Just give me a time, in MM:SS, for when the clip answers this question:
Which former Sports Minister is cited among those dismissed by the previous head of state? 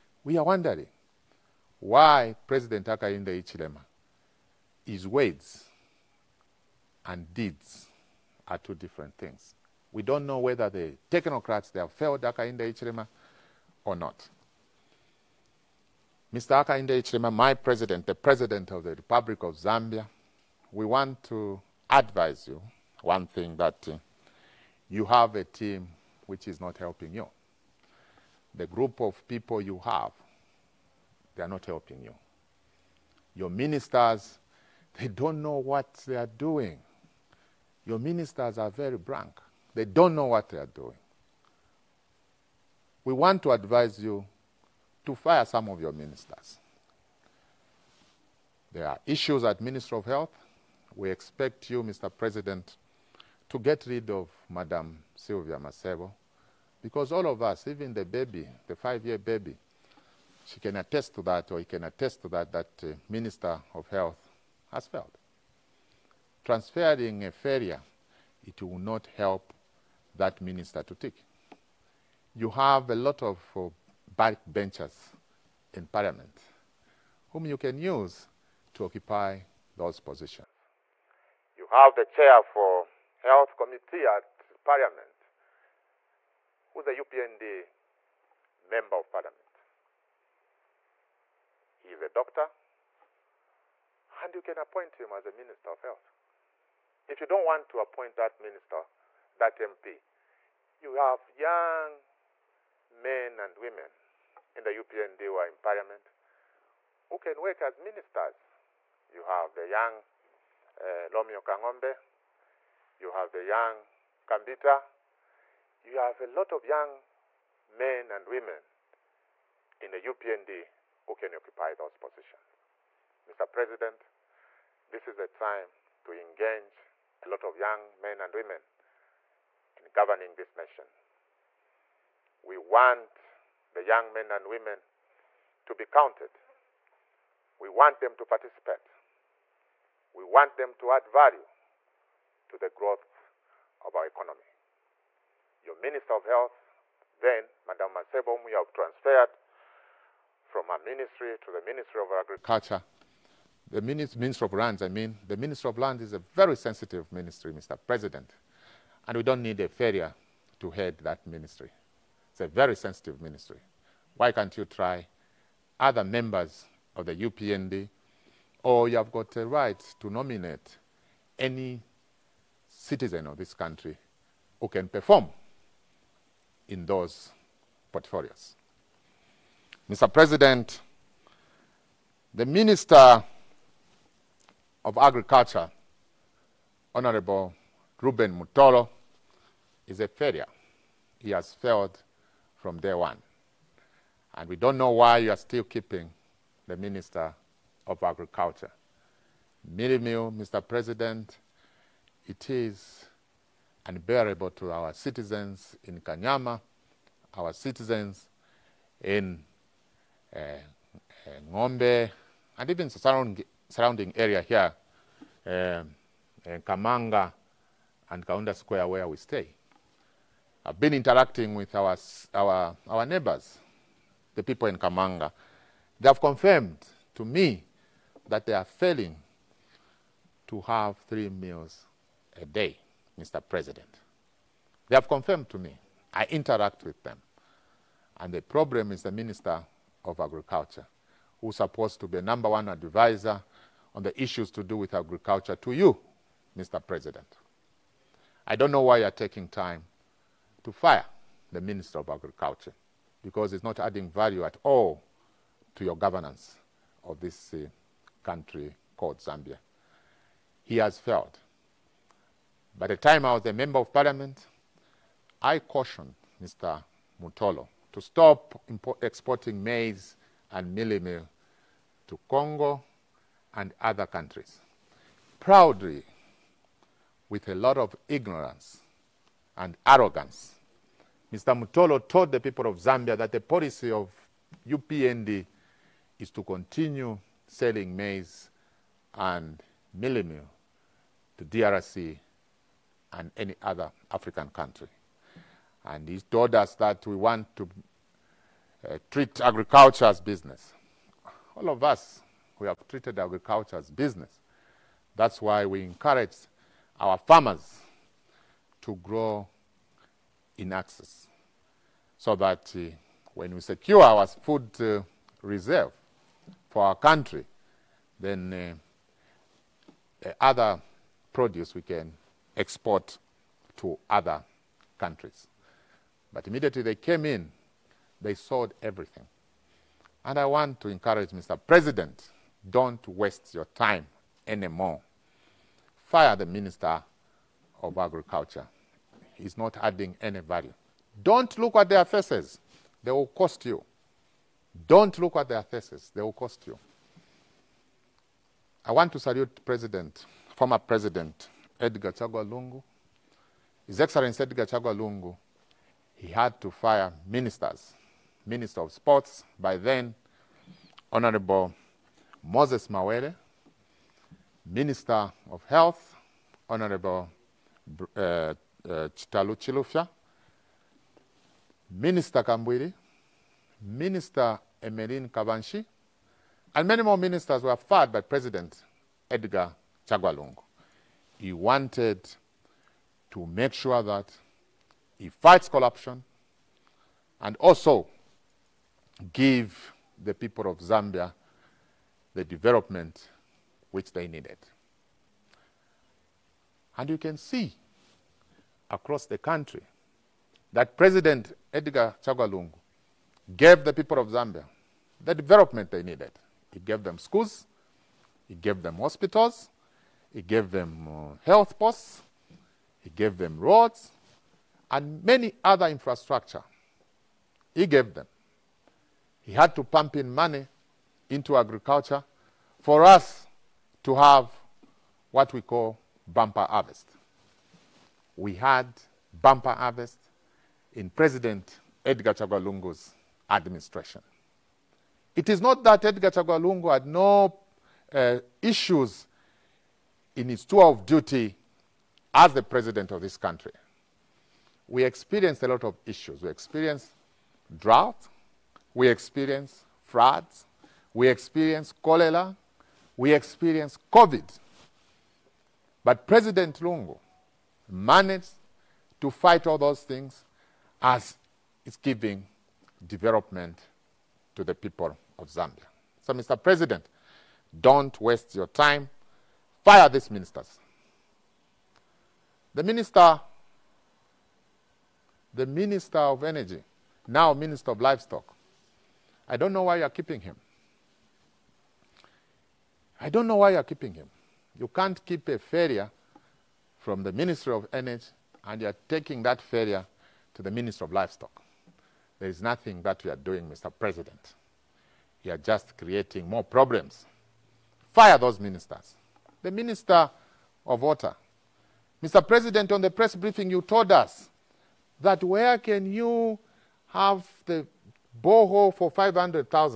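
06:02.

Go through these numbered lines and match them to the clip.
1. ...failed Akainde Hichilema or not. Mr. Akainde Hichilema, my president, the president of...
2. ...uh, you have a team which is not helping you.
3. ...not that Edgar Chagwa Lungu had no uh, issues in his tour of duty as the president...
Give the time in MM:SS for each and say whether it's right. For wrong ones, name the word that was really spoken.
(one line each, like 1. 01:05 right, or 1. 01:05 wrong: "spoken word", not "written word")
1. 00:11 right
2. 00:23 right
3. 07:15 right.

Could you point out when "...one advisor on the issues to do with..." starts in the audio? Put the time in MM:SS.
04:02.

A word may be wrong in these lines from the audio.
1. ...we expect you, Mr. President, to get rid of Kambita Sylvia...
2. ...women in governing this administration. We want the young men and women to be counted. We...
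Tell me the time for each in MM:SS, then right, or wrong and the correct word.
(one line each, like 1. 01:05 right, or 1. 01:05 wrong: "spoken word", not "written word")
1. 00:50 wrong: "Madam", not "Kambita"
2. 02:08 wrong: "nation", not "administration".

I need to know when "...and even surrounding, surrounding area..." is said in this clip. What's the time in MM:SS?
03:32.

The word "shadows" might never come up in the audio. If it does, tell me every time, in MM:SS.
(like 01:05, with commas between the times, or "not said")
not said.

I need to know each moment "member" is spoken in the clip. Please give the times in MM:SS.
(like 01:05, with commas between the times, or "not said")
01:28, 02:46, 04:23.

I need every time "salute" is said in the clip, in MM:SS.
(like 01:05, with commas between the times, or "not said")
05:49.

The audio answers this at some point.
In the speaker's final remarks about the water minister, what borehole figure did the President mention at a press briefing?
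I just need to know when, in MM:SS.
08:29.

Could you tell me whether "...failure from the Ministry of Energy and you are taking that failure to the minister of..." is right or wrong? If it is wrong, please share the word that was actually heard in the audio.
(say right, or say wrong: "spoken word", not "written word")
right.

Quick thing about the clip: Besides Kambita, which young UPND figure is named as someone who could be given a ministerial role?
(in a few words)
Romeo Kangombe.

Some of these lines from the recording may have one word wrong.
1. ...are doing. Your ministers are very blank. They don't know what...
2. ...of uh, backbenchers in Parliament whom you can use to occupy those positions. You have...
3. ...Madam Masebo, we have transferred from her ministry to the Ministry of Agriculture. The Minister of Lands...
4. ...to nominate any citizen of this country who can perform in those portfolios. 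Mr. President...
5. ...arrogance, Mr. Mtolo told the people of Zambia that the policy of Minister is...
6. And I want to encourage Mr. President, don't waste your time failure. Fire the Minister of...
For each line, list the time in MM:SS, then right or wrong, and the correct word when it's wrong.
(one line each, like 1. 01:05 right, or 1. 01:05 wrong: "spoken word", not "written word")
1. 00:36 right
2. 01:13 right
3. 02:27 right
4. 02:49 right
5. 04:39 wrong: "UPND", not "Minister"
6. 05:30 wrong: "anymore", not "failure".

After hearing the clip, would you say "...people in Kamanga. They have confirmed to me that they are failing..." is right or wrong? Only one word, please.
right.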